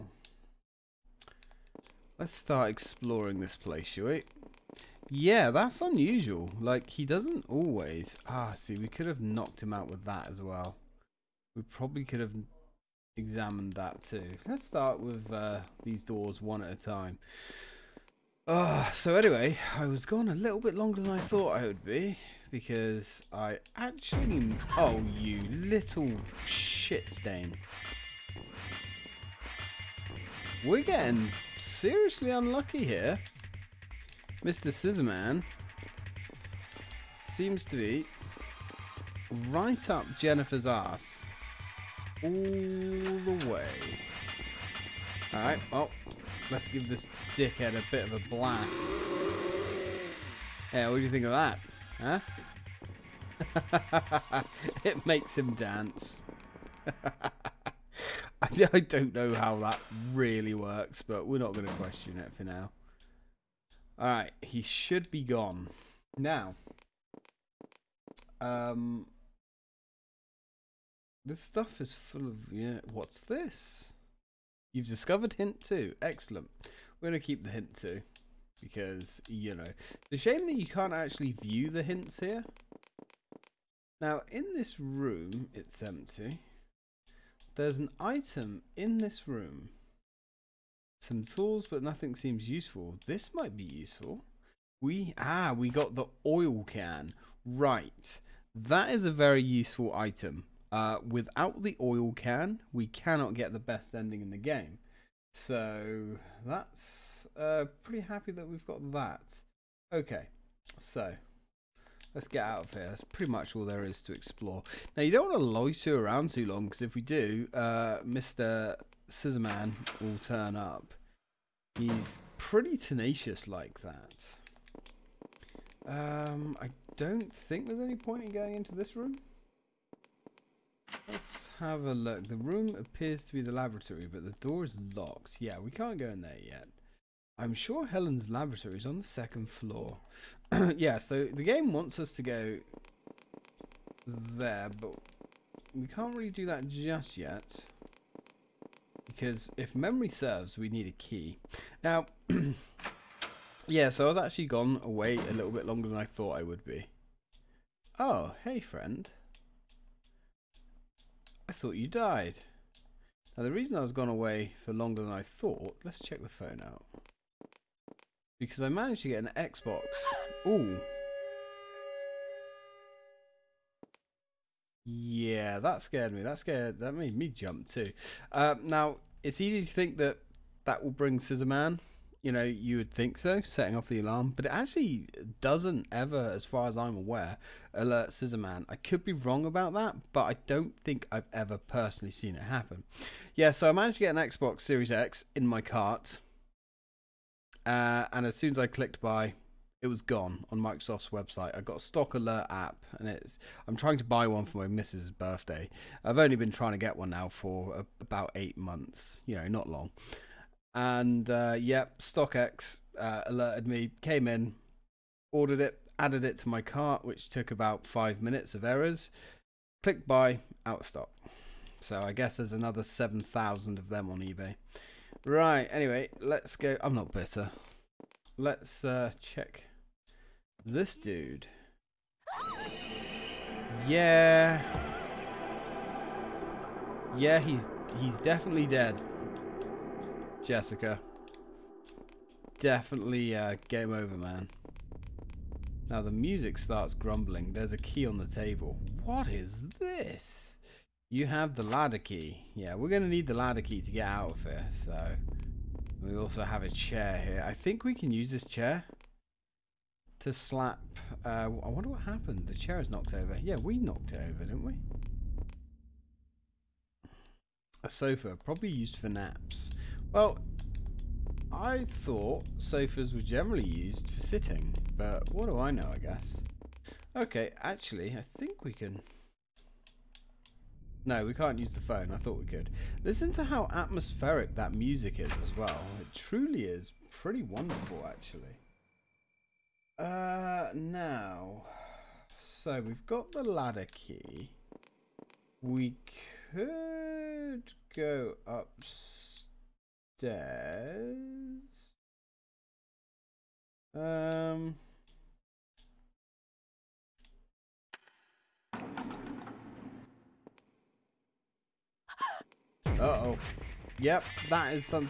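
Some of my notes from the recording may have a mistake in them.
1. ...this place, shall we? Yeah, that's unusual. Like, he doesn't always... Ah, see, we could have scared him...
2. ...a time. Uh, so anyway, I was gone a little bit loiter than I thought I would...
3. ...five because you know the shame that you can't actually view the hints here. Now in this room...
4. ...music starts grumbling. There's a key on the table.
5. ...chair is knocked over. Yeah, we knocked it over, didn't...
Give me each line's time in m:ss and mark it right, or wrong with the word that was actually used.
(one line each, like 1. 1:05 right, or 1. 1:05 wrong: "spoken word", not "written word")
1. 0:03 wrong: "knocked", not "scared"
2. 0:16 wrong: "longer", not "loiter"
3. 1:17 wrong: "two", not "five"
4. 4:06 right
5. 4:22 right.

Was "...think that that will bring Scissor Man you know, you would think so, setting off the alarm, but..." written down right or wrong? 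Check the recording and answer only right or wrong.
right.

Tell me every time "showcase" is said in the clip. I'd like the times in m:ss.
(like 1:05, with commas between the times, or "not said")
not said.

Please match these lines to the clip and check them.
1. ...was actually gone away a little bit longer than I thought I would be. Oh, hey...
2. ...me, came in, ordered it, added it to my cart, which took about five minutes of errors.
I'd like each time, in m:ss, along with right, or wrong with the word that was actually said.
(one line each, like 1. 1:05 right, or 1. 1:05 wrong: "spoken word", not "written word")
1. 2:34 right
2. 3:33 right.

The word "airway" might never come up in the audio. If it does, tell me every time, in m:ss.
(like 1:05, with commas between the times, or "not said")
not said.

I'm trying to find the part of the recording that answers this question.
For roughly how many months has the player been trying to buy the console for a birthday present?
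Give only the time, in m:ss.
3:28.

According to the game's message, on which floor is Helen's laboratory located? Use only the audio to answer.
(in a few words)
second floor.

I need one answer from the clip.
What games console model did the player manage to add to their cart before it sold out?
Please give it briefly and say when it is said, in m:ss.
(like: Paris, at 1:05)
Xbox Series X, at 3:14.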